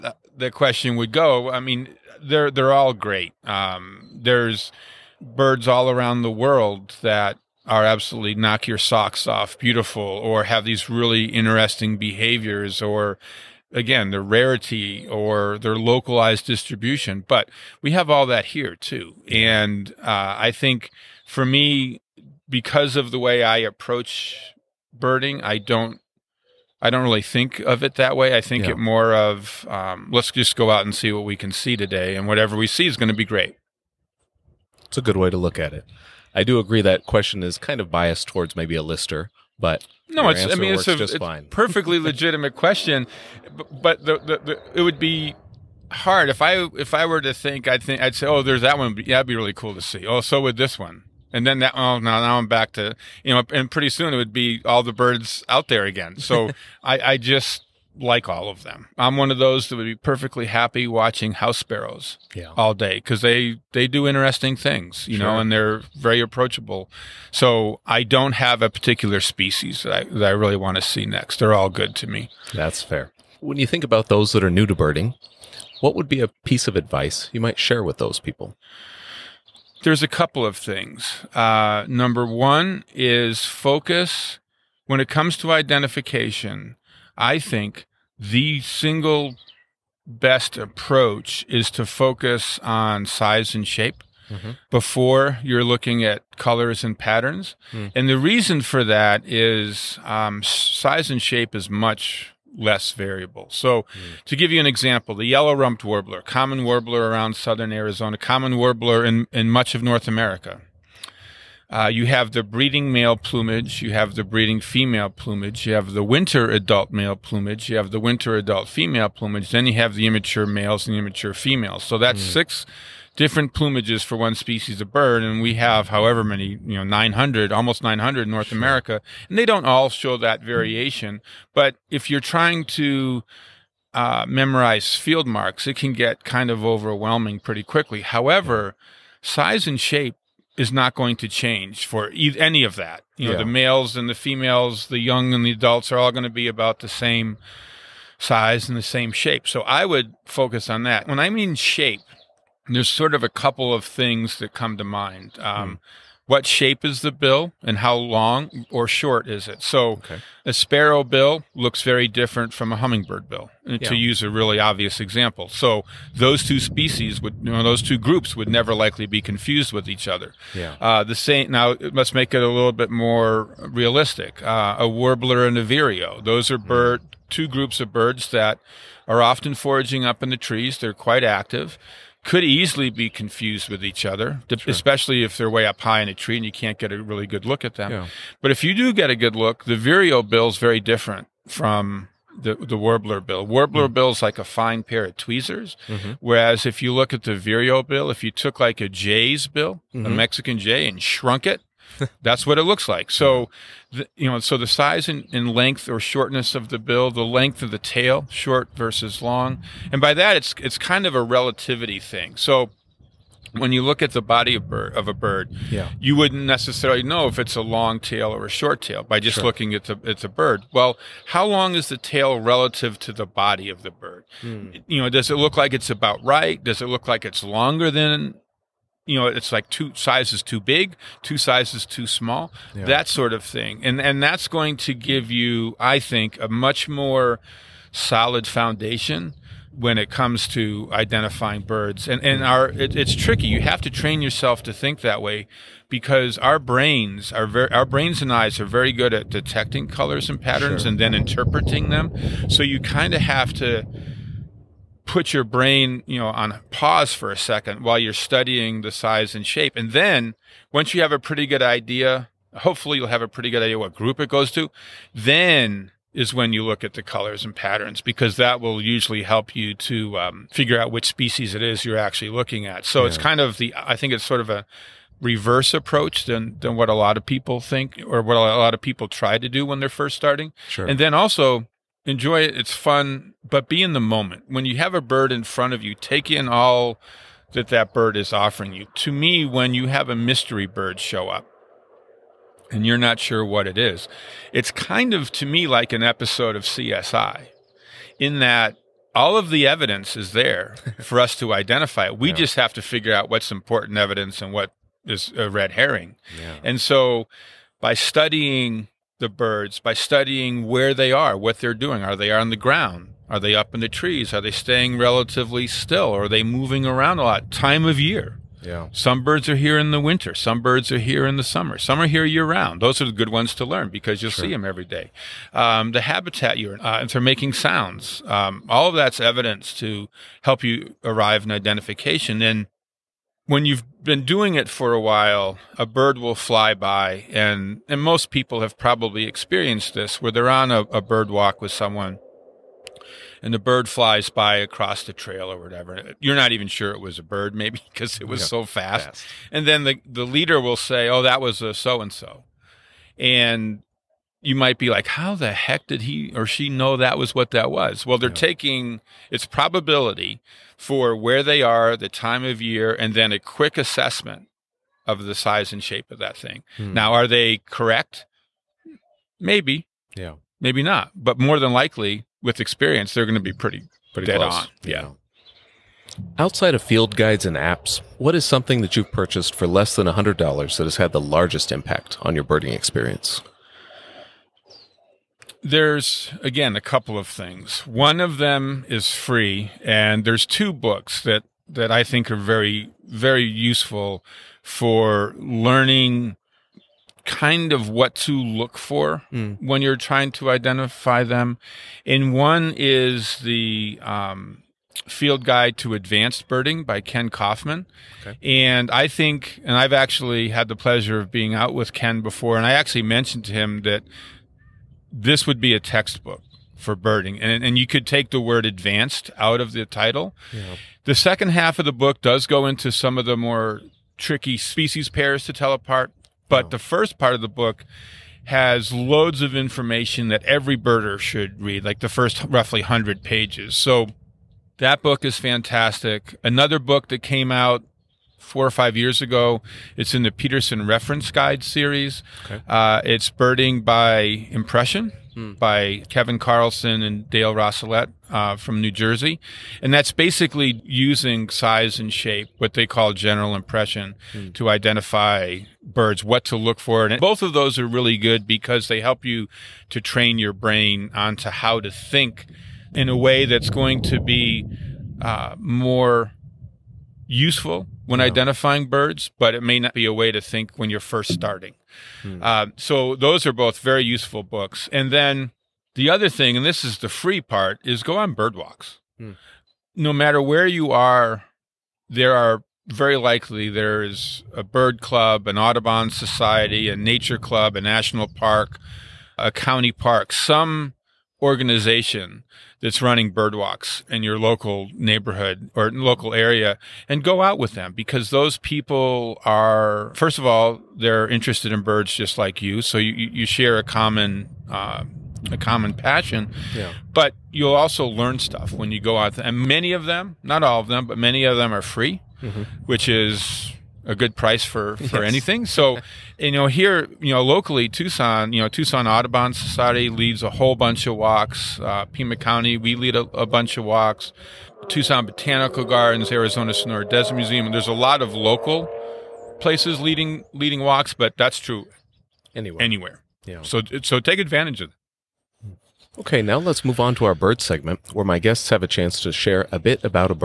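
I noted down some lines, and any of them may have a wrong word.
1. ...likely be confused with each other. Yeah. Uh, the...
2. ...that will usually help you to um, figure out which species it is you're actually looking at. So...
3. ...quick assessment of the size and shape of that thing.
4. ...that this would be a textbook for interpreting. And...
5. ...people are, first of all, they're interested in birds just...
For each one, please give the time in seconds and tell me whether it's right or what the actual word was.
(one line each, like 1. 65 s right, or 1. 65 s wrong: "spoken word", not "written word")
1. 168 s right
2. 268 s right
3. 363 s right
4. 413 s wrong: "birding", not "interpreting"
5. 498 s right.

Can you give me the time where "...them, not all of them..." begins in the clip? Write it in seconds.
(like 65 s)
510 s.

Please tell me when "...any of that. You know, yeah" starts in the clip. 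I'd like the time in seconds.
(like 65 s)
142 s.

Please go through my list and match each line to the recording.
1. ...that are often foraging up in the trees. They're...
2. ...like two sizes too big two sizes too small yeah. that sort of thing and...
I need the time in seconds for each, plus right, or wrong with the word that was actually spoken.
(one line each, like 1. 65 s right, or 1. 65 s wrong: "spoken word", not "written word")
1. 178 s right
2. 229 s right.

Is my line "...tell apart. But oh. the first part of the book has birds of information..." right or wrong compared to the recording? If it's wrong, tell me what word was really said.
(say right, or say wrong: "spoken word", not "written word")
wrong: "loads", not "birds".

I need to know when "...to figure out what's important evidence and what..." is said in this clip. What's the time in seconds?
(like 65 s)
302 s.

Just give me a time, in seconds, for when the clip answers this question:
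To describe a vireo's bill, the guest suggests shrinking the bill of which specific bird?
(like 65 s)
200 s.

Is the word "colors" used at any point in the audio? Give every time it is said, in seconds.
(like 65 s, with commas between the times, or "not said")
96 s, 249 s, 267 s.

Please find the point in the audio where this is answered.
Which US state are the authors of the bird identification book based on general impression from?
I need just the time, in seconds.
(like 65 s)
448 s.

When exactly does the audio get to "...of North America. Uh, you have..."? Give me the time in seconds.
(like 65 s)
109 s.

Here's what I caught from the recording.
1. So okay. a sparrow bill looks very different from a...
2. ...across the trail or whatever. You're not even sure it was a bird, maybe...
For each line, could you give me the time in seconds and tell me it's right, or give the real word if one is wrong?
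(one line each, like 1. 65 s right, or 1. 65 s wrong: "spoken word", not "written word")
1. 159 s right
2. 344 s right.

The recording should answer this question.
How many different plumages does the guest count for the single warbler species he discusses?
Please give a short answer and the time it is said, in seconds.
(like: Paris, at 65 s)
6, at 122 s.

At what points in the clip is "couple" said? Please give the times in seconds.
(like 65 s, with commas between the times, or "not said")
80 s, 153 s, 386 s.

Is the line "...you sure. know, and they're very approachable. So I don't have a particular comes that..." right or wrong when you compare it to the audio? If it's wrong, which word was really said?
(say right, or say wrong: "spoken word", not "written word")
wrong: "species", not "comes".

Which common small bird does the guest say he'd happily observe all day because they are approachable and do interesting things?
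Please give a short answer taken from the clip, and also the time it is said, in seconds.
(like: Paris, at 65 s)
House sparrows, at 61 s.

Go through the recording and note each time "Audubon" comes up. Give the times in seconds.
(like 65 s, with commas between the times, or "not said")
485 s, 519 s.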